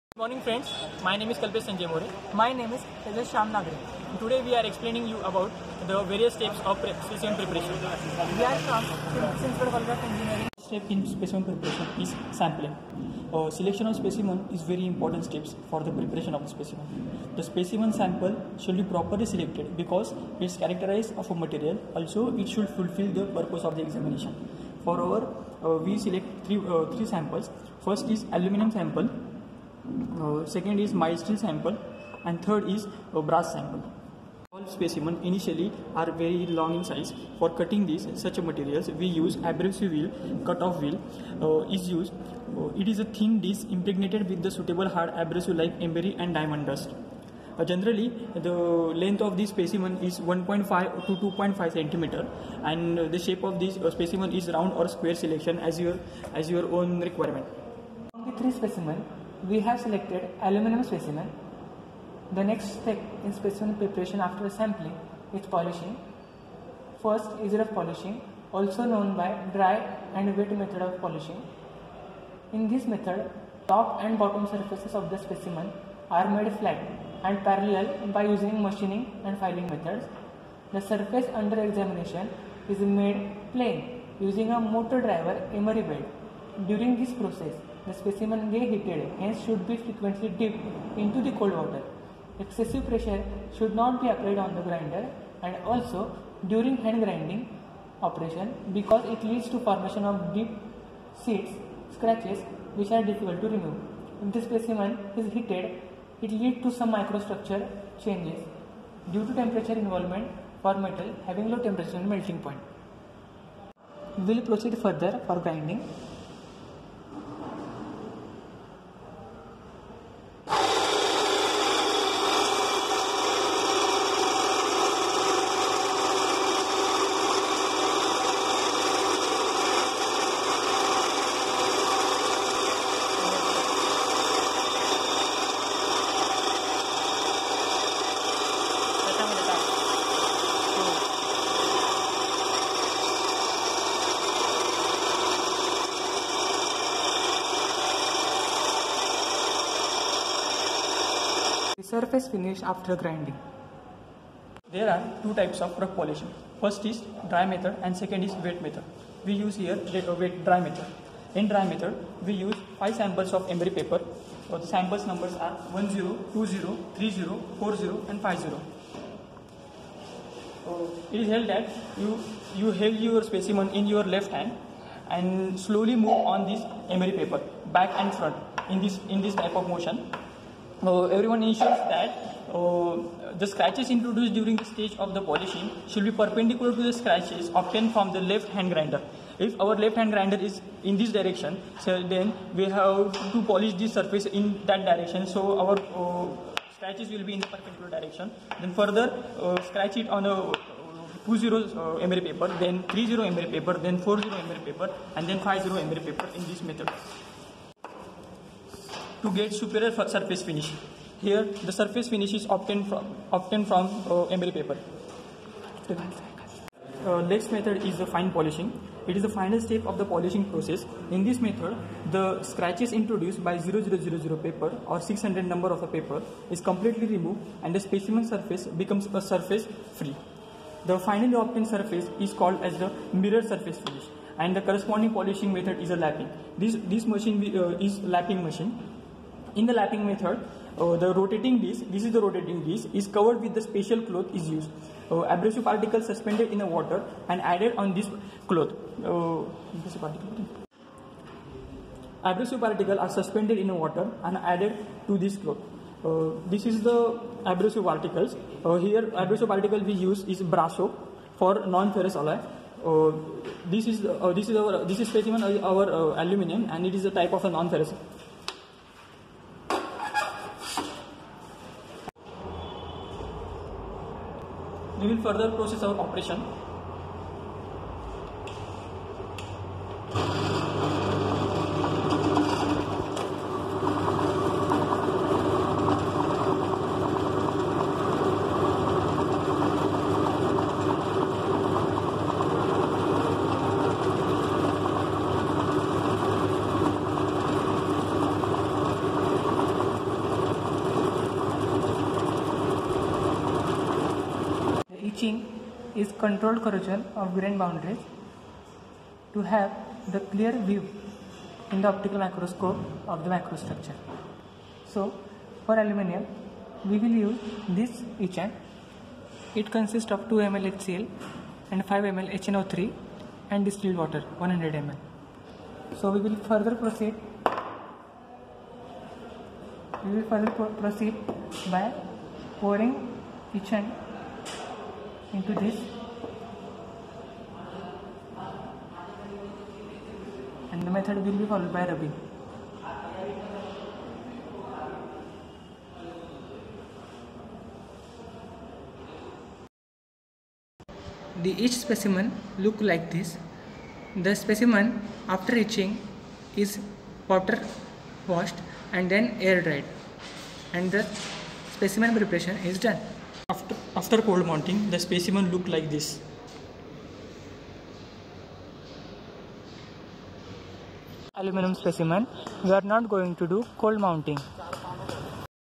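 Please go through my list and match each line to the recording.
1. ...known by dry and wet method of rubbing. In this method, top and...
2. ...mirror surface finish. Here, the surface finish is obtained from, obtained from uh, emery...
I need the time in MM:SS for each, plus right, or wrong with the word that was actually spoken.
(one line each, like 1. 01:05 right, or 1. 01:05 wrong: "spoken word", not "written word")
1. 01:08 wrong: "polishing", not "rubbing"
2. 03:29 wrong: "superior", not "mirror".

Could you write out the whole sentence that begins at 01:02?
The next step in specimen preparation after sampling is polishing.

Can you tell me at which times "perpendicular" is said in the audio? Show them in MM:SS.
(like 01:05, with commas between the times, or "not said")
03:06, 03:17.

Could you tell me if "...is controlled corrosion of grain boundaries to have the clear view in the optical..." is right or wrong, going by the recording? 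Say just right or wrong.
right.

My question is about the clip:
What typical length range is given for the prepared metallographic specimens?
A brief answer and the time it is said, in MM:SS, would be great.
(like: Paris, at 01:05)
1.5 to 2.5 centimeter, at 00:50.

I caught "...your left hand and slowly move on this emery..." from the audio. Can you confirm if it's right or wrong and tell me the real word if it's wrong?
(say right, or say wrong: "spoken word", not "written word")
right.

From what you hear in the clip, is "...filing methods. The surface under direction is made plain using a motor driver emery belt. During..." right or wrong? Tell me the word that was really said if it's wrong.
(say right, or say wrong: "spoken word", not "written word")
wrong: "examination", not "direction".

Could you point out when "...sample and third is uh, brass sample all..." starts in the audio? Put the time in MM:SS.
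00:31.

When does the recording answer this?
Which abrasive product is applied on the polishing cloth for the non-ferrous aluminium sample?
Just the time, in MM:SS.
04:20.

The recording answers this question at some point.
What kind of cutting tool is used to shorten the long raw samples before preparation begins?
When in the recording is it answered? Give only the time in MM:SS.
00:39.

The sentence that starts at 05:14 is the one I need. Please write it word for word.
So for aluminium, we will use this etchant.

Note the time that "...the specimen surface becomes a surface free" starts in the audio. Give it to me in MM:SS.
03:47.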